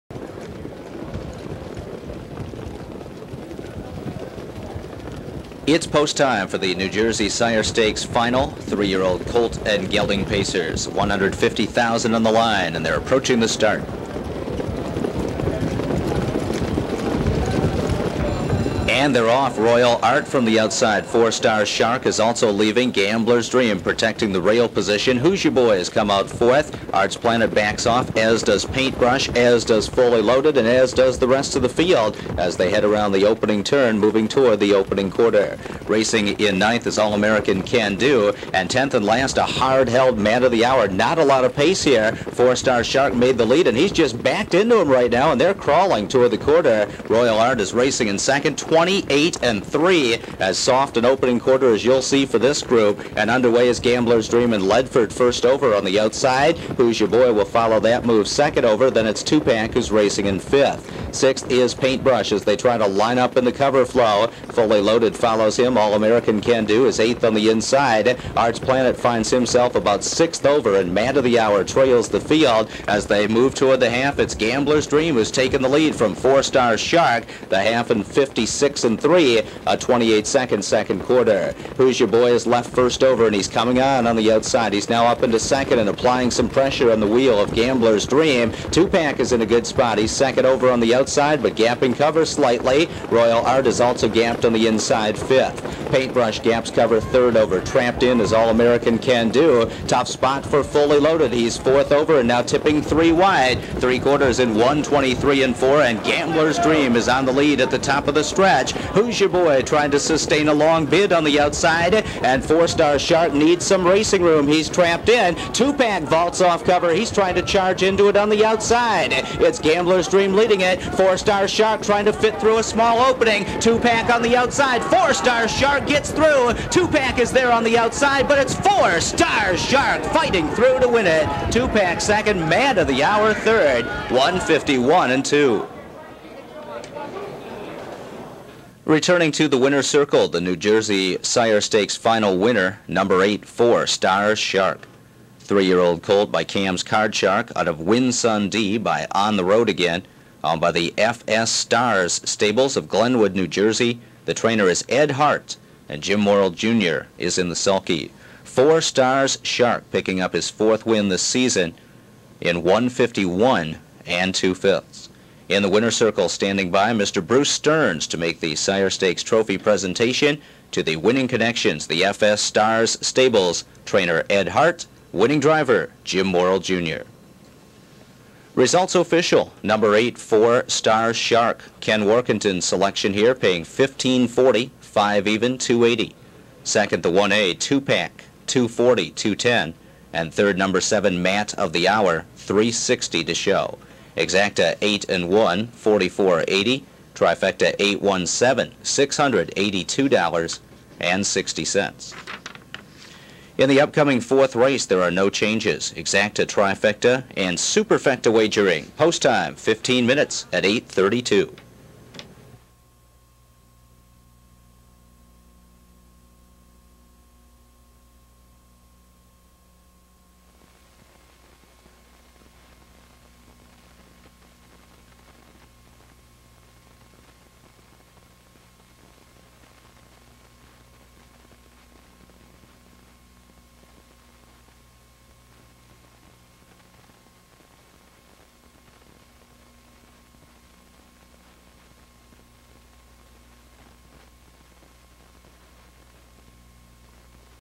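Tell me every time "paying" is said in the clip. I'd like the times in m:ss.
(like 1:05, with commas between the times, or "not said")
3:03.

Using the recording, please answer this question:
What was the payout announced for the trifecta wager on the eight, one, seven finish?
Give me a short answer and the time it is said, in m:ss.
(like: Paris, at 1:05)
$682.60, at 3:18.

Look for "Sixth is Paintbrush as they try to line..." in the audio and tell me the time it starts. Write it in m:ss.
1:01.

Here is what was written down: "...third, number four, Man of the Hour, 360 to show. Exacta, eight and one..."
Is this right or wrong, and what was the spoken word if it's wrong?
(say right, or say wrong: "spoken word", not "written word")
wrong: "seven", not "four".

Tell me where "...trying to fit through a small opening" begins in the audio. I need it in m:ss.
2:01.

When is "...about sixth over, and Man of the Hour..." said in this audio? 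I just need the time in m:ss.
1:09.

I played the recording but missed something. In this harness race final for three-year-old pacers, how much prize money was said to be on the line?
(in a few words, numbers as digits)
150,000.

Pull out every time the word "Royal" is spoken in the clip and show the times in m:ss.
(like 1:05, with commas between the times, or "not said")
0:19, 0:47, 1:33.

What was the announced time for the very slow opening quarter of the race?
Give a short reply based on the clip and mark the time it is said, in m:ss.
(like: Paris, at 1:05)
28 and 3, at 0:48.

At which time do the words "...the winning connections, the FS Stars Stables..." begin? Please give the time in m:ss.
2:50.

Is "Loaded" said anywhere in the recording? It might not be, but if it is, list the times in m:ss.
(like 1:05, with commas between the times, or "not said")
0:30, 1:04, 1:40.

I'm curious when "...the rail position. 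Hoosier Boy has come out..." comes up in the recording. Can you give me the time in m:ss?
0:24.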